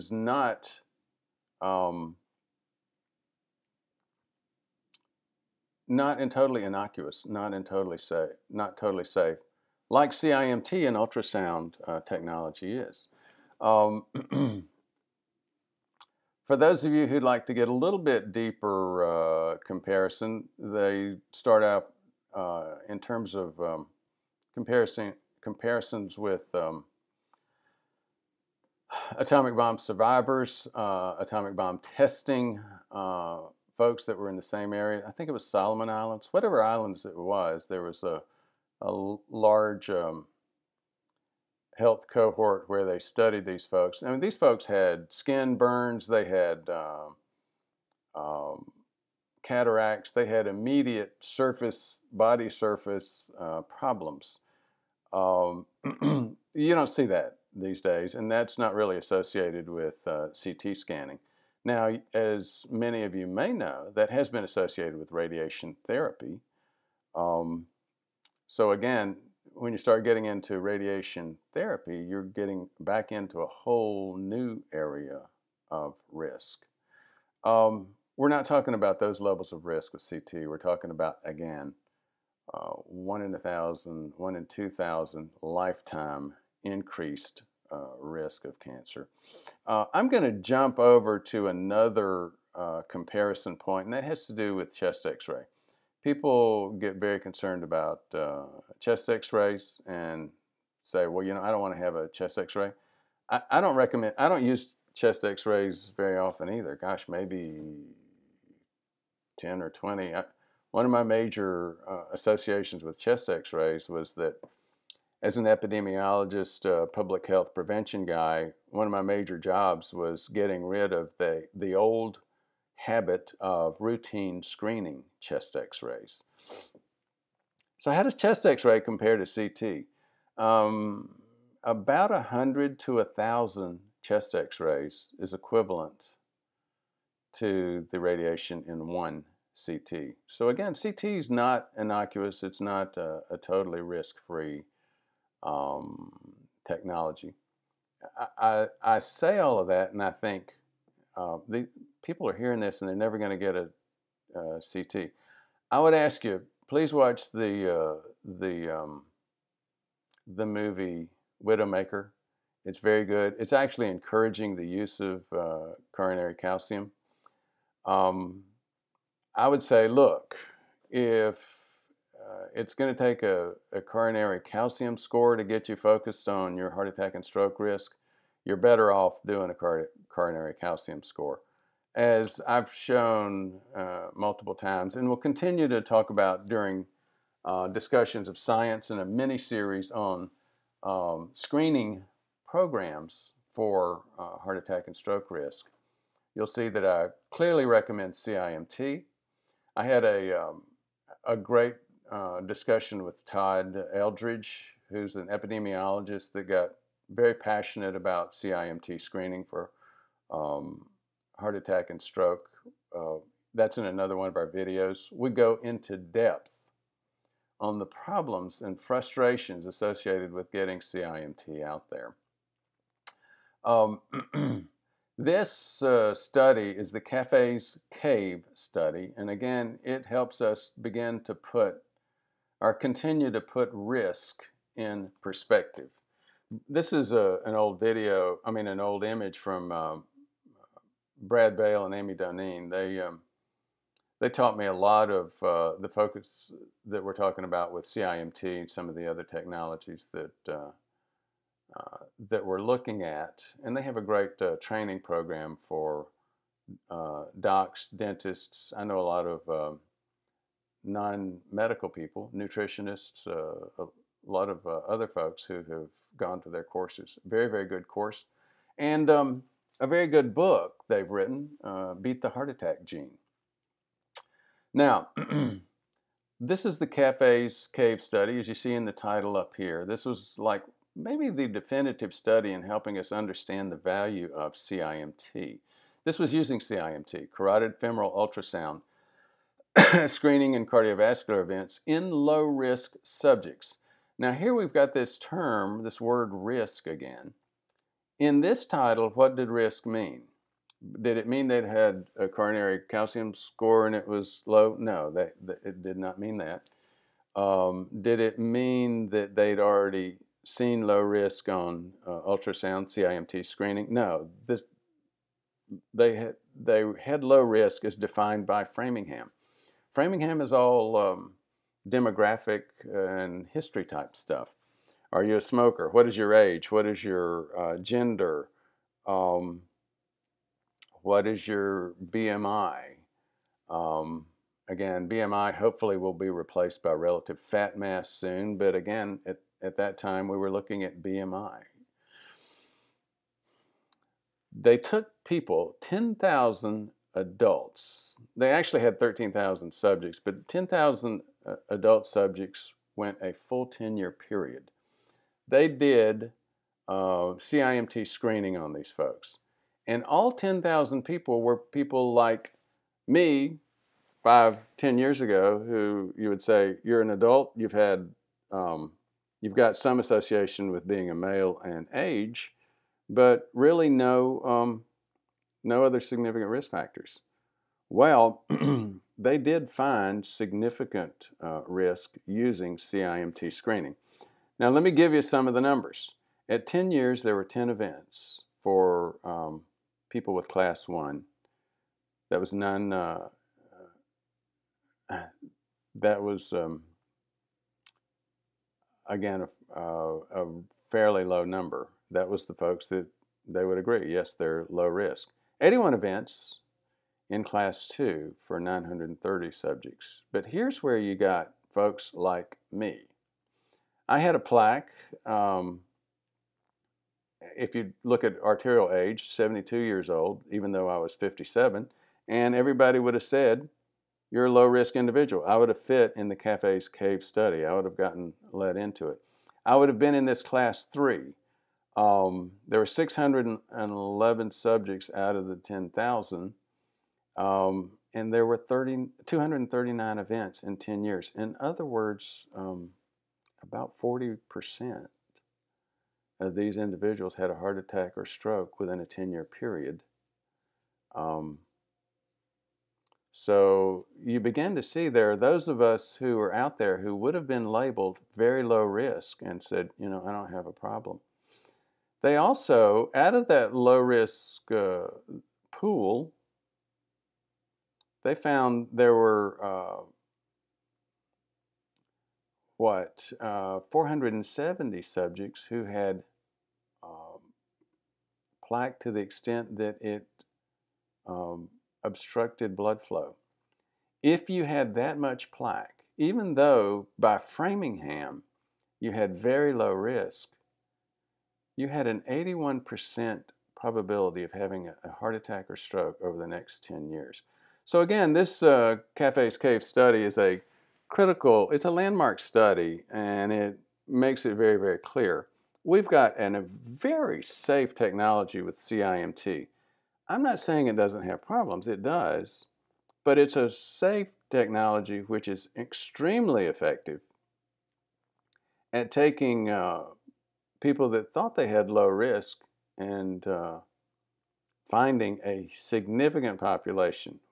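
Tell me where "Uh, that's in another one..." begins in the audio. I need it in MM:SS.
03:32.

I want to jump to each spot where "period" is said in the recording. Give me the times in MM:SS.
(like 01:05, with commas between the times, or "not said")
05:54, 07:29.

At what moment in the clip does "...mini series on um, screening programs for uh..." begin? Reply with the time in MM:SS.
03:09.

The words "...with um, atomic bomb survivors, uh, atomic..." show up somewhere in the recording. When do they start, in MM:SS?
00:26.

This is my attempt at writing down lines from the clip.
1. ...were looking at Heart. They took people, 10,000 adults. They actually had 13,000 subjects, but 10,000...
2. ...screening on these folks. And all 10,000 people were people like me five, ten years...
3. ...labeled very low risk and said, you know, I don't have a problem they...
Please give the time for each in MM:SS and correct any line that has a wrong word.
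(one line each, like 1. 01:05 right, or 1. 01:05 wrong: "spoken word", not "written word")
1. 05:40 wrong: "BMI", not "Heart"
2. 05:58 right
3. 07:37 right.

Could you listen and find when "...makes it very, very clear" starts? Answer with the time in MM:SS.
08:24.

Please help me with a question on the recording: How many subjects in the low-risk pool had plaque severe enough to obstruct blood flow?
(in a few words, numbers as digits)
470.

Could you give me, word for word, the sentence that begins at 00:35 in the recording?
I think it was Solomon Islands, whatever islands it was.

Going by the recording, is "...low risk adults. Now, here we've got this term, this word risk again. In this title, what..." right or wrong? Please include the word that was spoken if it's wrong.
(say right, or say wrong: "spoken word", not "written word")
wrong: "subjects", not "adults".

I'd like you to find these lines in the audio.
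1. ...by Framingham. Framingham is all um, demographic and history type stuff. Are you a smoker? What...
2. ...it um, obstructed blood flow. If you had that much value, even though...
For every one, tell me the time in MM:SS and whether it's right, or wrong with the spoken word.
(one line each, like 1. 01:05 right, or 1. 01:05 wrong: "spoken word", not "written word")
1. 05:18 right
2. 08:00 wrong: "plaque", not "value".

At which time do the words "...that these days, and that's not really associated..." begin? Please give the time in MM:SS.
00:57.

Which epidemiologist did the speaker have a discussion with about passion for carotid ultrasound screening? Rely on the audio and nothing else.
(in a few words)
Todd Eldridge.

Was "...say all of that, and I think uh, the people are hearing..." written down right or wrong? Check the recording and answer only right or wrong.
right.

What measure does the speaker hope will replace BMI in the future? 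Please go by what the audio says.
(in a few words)
relative fat mass.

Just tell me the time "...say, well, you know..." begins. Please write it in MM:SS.
01:40.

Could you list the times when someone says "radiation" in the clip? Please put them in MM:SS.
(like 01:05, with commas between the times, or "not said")
01:05, 01:10, 02:17.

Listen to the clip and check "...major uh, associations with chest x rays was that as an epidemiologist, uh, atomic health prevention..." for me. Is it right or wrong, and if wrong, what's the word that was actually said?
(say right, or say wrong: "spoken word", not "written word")
wrong: "public", not "atomic".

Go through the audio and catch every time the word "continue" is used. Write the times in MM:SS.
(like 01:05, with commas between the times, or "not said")
03:05, 03:52.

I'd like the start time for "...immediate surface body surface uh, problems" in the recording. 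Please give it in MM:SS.
00:50.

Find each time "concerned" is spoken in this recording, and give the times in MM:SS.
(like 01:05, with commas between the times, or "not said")
01:37.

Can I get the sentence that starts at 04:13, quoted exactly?
And they have a great uh, training program for uh, docs, dentists.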